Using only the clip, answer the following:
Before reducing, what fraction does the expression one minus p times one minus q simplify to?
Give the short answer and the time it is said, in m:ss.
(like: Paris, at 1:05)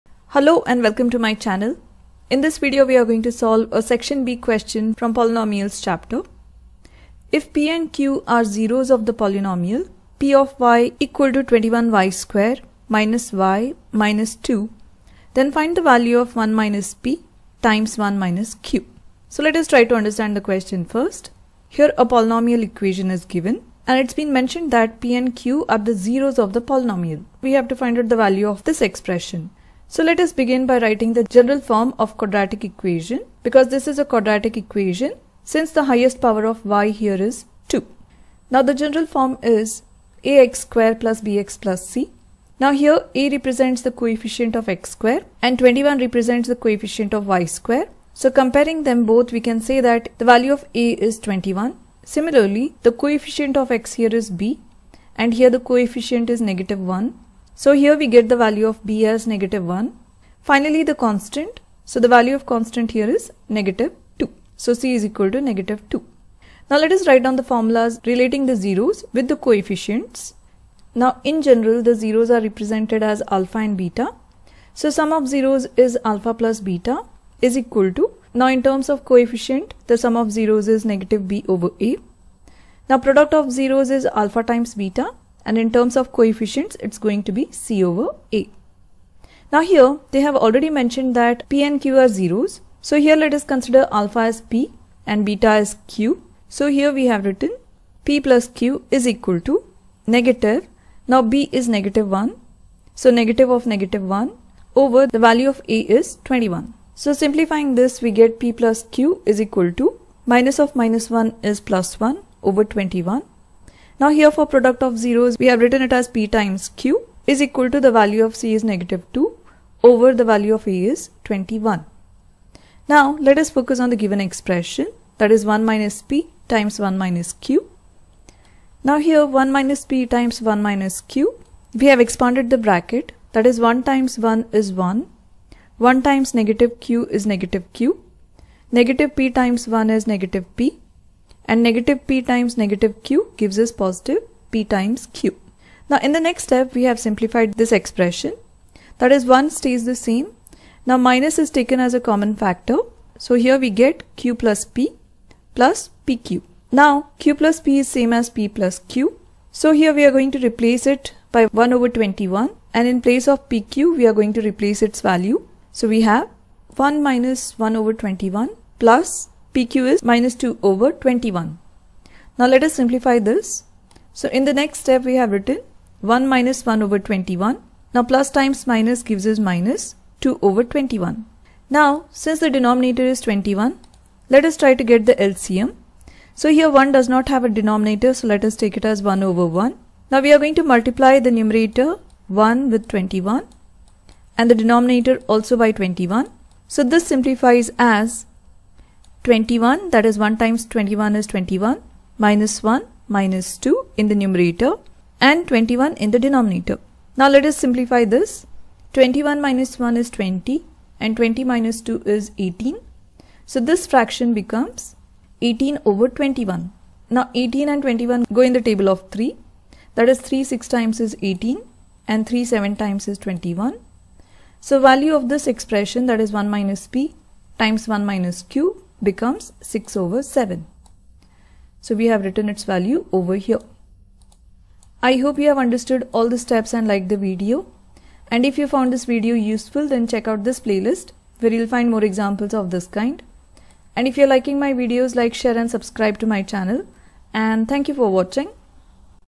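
18/21, at 3:35.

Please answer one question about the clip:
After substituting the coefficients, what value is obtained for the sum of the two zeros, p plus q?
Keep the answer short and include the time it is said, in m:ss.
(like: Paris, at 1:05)
1/21, at 1:51.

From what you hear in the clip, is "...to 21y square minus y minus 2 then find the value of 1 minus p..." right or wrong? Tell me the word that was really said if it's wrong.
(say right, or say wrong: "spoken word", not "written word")
right.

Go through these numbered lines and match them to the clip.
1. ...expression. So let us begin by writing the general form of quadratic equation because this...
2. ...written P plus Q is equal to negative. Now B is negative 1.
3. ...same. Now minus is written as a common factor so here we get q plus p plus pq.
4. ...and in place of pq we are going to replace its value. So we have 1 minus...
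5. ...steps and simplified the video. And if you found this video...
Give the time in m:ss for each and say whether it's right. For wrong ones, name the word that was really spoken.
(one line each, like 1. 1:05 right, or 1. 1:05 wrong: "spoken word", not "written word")
1. 0:28 right
2. 1:37 right
3. 2:29 wrong: "taken", not "written"
4. 2:42 right
5. 3:56 wrong: "liked", not "simplified".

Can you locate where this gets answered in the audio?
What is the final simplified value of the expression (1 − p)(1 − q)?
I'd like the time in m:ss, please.
3:49.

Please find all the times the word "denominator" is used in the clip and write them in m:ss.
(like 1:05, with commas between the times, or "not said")
3:02, 3:07, 3:14, 3:26.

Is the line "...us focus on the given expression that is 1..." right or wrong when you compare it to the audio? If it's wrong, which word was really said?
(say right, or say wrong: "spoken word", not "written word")
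right.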